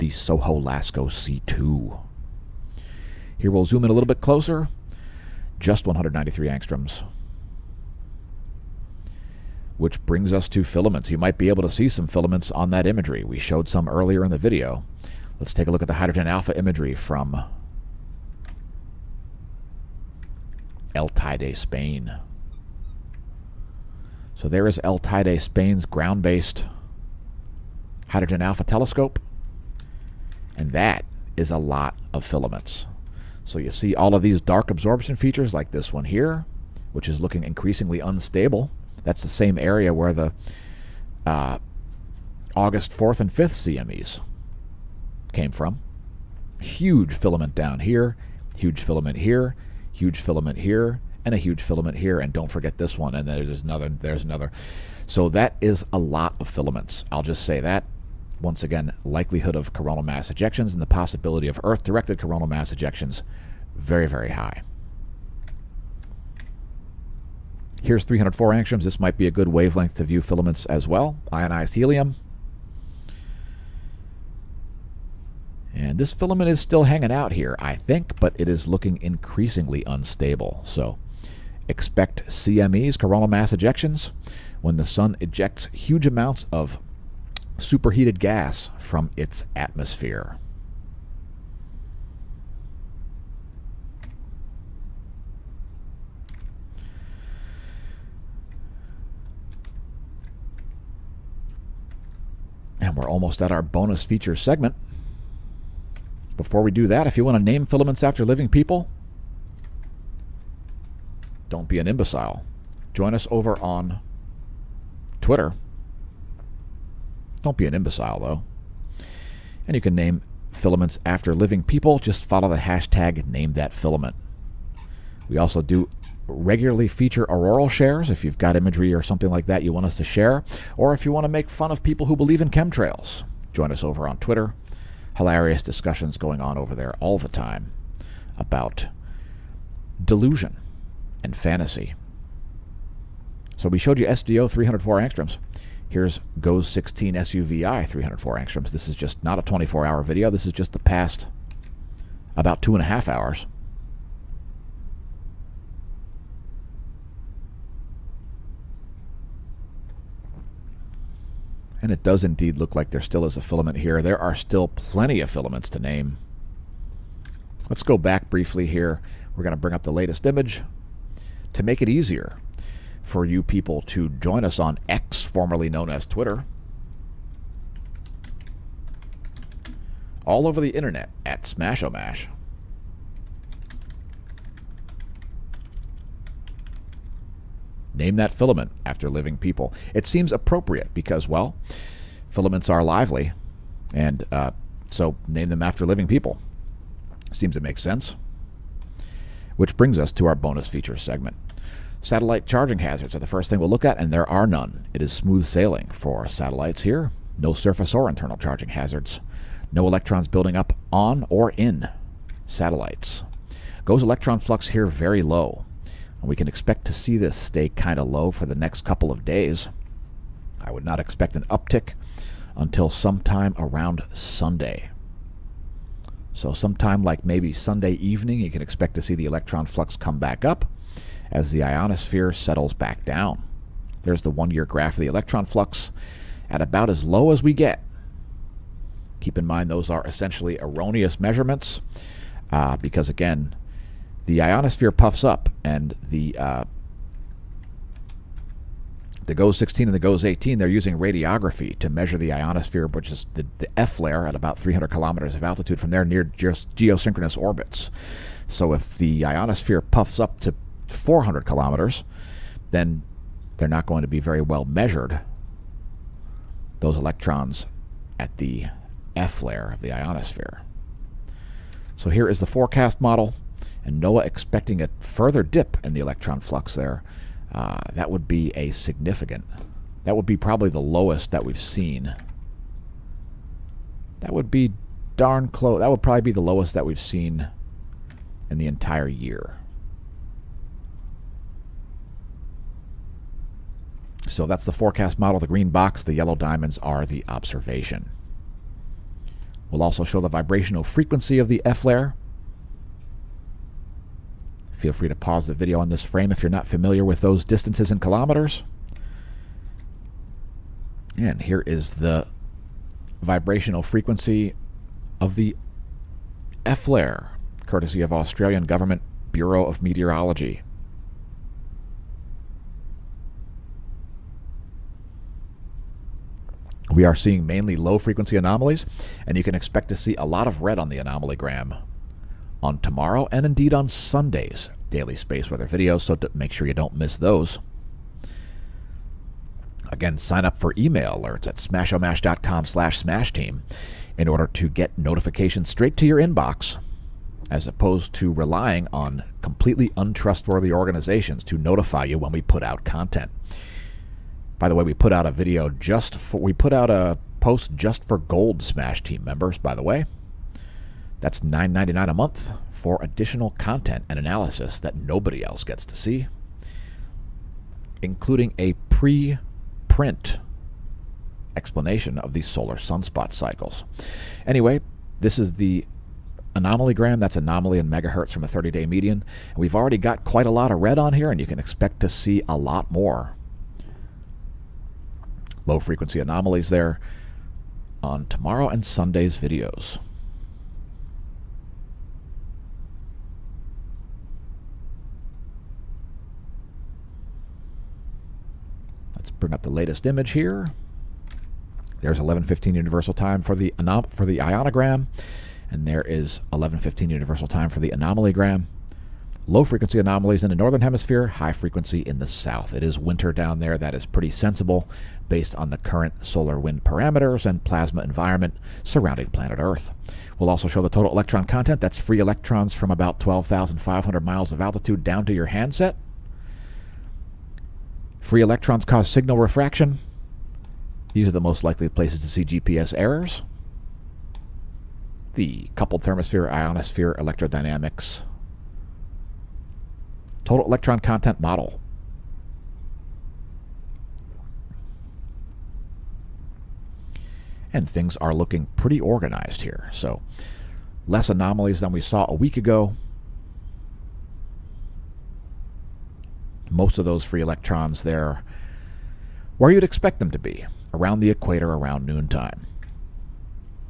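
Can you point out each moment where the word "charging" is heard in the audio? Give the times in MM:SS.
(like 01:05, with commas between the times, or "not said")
03:22, 03:28.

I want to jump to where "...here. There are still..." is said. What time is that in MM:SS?
02:43.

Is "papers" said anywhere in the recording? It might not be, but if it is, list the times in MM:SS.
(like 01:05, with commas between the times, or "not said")
not said.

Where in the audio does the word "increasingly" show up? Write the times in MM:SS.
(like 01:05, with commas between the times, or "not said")
00:37, 01:19.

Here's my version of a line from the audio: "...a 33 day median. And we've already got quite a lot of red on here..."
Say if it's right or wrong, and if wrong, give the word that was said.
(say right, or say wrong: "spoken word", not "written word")
wrong: "30", not "33".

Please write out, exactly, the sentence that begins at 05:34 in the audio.
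Daily space weather videos, so make sure you don't miss those.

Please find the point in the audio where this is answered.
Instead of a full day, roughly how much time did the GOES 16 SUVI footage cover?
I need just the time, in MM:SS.
02:32.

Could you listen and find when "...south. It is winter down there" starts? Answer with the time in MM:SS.
06:52.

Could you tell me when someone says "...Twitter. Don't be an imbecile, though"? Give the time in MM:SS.
01:55.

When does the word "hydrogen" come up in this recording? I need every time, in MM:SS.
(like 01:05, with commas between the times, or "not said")
00:15, 00:28.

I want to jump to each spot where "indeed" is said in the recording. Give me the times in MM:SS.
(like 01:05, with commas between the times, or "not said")
02:42, 05:33.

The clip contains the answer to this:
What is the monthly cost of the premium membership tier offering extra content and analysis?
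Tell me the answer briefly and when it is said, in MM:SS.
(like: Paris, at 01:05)
$9.99, at 06:01.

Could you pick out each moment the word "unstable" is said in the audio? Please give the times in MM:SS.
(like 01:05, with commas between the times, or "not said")
00:37, 01:19.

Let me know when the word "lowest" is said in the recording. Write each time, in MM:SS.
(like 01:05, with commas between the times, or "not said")
04:40, 04:46.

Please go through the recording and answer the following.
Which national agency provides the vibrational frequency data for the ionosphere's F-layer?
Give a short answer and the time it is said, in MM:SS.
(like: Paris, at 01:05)
Australian Government Bureau of Meteorology, at 05:18.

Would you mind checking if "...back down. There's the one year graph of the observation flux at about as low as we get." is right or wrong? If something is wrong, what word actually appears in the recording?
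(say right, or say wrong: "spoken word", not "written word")
wrong: "electron", not "observation".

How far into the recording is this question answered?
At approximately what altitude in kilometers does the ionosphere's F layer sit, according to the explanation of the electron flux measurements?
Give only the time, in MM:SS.
04:14.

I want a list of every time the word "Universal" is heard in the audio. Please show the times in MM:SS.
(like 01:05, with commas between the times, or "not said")
06:42, 06:47.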